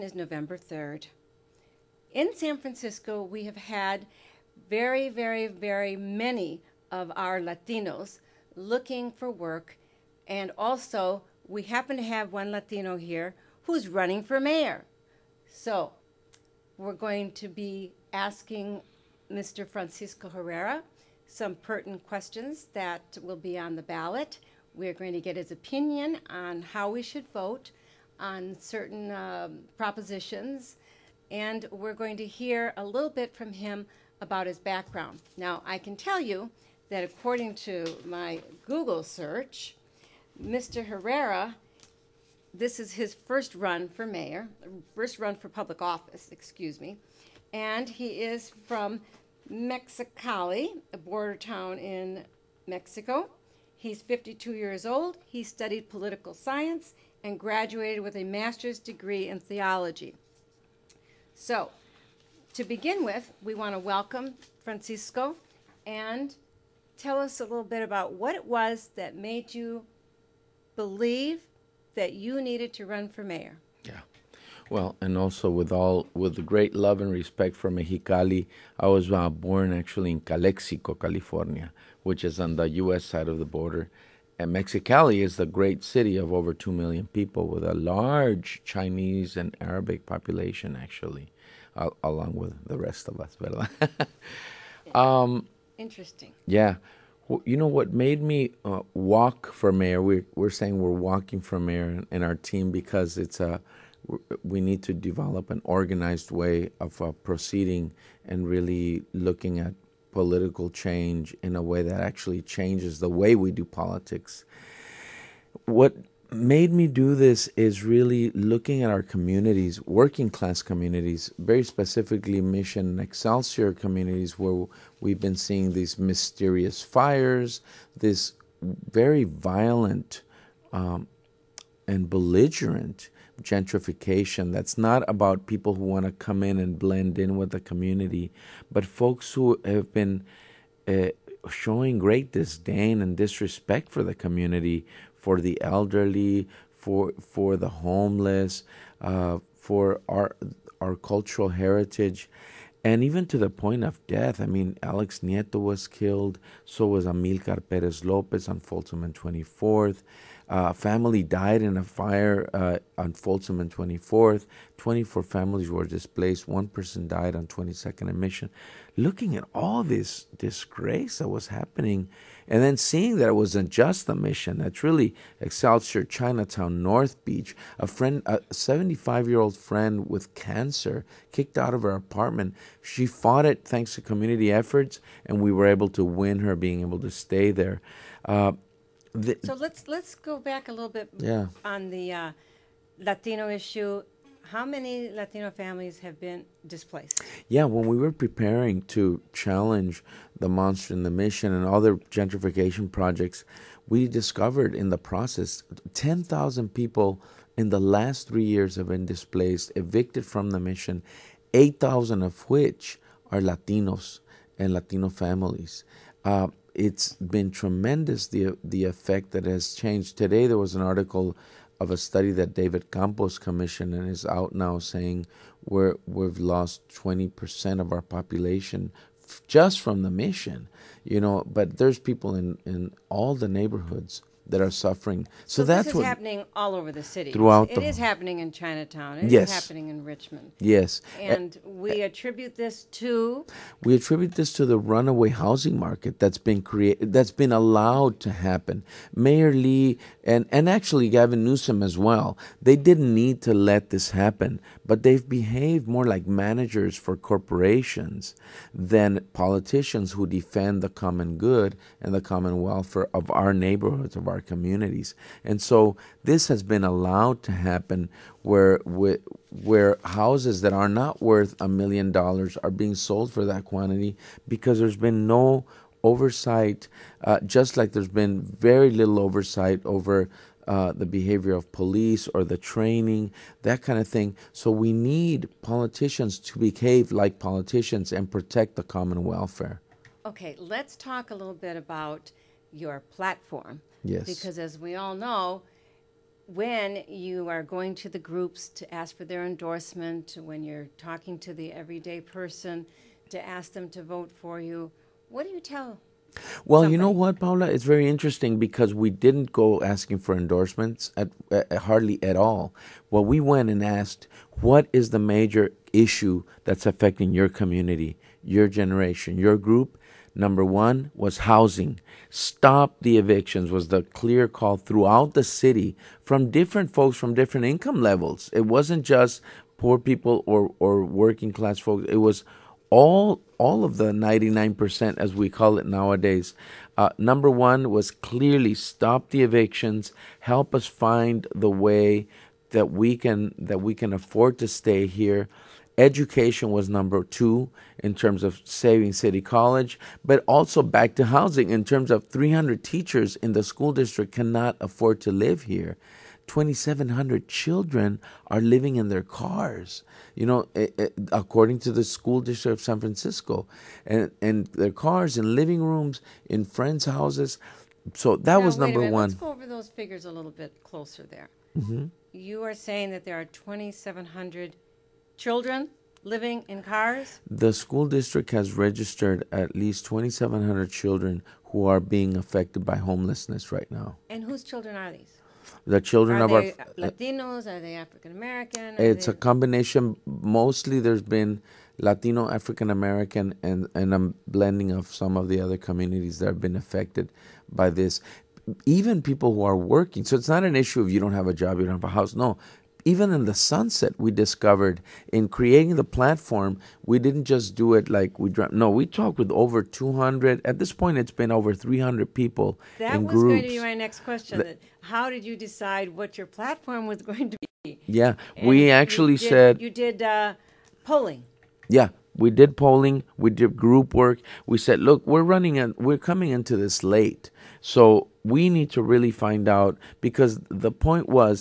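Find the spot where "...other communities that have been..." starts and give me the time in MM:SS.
06:35.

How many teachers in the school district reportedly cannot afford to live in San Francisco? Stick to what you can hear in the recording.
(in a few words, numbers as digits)
300.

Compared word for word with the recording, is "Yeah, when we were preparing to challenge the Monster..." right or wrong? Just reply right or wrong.
right.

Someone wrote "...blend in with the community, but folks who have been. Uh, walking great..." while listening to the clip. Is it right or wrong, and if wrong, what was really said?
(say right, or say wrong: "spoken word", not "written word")
wrong: "showing", not "walking".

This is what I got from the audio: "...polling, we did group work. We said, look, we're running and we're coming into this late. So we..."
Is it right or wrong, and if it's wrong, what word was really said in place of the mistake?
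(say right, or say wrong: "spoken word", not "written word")
right.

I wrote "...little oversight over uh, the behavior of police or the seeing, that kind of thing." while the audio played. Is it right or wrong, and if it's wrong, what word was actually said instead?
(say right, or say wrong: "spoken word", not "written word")
wrong: "training", not "seeing".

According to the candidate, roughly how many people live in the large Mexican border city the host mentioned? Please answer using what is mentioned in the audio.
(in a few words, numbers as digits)
over 2 million.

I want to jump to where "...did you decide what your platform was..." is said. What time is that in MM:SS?
06:55.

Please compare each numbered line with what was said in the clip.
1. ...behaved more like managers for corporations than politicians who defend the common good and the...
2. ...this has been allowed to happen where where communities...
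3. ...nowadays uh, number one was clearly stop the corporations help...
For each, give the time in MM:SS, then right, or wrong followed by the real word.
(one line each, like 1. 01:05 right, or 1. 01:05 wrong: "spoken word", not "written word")
1. 04:15 right
2. 04:26 wrong: "houses", not "communities"
3. 05:35 wrong: "evictions", not "corporations".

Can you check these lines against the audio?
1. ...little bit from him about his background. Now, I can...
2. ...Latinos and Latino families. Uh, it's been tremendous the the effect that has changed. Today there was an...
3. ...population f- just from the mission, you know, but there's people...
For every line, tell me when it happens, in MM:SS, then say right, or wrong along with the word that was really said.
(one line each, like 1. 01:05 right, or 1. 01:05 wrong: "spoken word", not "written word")
1. 00:32 right
2. 03:33 right
3. 03:48 right.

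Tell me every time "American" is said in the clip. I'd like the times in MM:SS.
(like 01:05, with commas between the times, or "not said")
06:28, 06:32.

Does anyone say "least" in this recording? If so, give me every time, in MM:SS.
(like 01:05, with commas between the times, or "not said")
06:19.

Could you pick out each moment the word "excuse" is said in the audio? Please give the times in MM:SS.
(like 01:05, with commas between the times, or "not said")
00:46.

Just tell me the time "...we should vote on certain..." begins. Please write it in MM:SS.
00:26.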